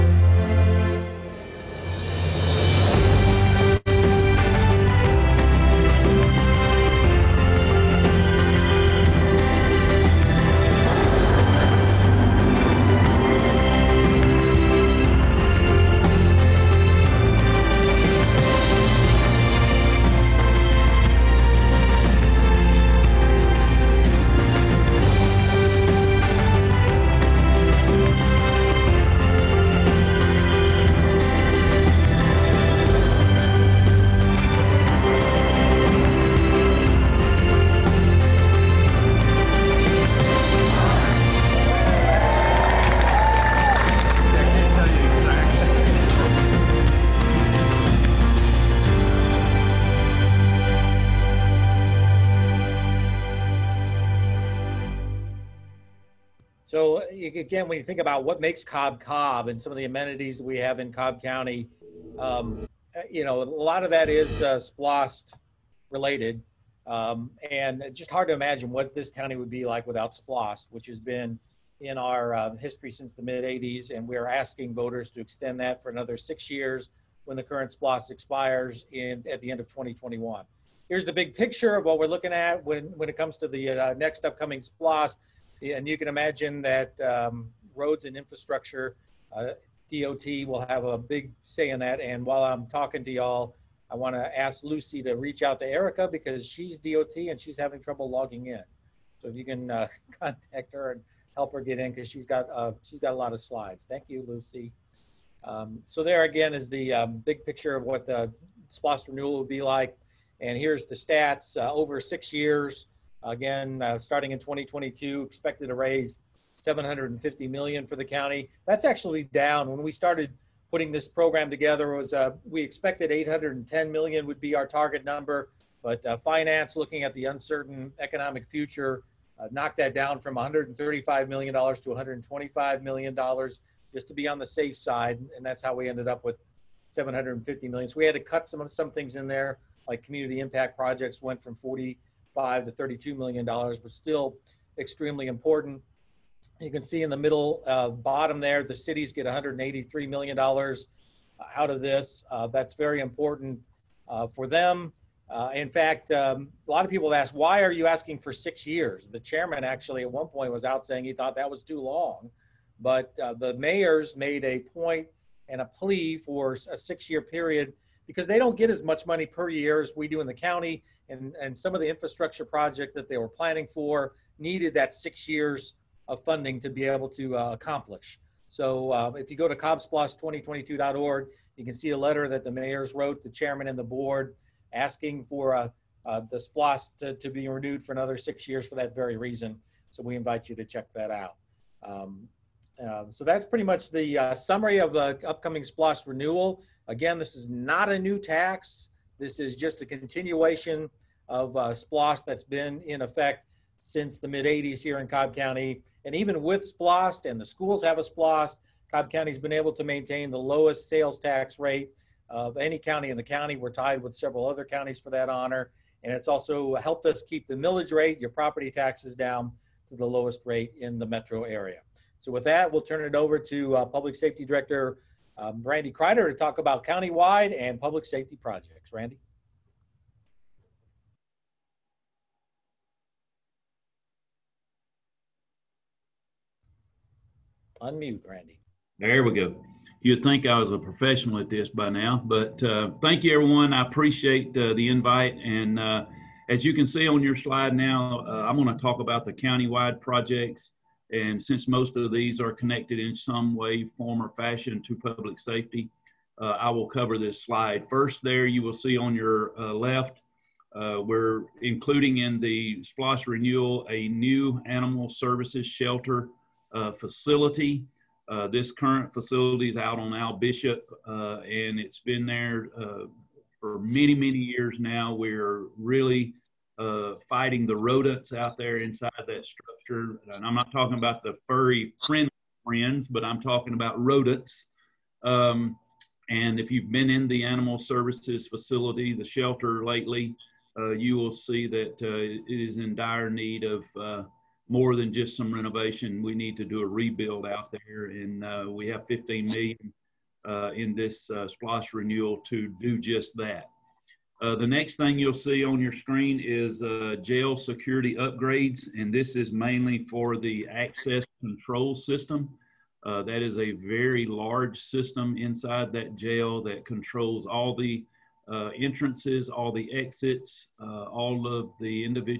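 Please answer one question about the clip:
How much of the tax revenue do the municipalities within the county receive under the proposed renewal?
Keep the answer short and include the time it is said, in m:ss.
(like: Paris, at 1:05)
$183 million, at 2:29.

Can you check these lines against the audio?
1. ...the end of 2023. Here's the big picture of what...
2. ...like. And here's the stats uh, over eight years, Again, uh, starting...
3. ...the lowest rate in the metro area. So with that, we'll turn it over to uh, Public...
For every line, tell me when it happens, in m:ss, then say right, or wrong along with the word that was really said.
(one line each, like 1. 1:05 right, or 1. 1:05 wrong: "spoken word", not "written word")
1. 1:19 wrong: "2021", not "2023"
2. 1:49 wrong: "six", not "eight"
3. 3:39 right.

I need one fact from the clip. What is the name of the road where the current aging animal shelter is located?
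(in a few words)
Al Bishop.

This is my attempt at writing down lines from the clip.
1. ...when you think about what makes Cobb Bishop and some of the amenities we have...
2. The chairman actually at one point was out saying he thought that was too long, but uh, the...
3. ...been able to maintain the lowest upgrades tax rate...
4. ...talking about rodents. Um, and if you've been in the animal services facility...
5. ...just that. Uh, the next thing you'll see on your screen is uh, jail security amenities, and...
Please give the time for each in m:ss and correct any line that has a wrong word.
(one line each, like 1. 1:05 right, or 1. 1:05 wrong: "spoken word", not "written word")
1. 0:57 wrong: "Cobb", not "Bishop"
2. 2:39 right
3. 3:29 wrong: "sales", not "upgrades"
4. 4:43 right
5. 5:02 wrong: "upgrades", not "amenities".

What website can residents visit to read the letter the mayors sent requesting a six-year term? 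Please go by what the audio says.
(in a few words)
cobbsplost2022.org.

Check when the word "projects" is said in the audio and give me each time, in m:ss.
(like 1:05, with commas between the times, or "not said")
2:20, 2:52, 3:48, 4:10.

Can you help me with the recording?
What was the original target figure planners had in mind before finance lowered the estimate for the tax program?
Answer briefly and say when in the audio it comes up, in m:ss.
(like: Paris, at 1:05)
$810 million, at 2:03.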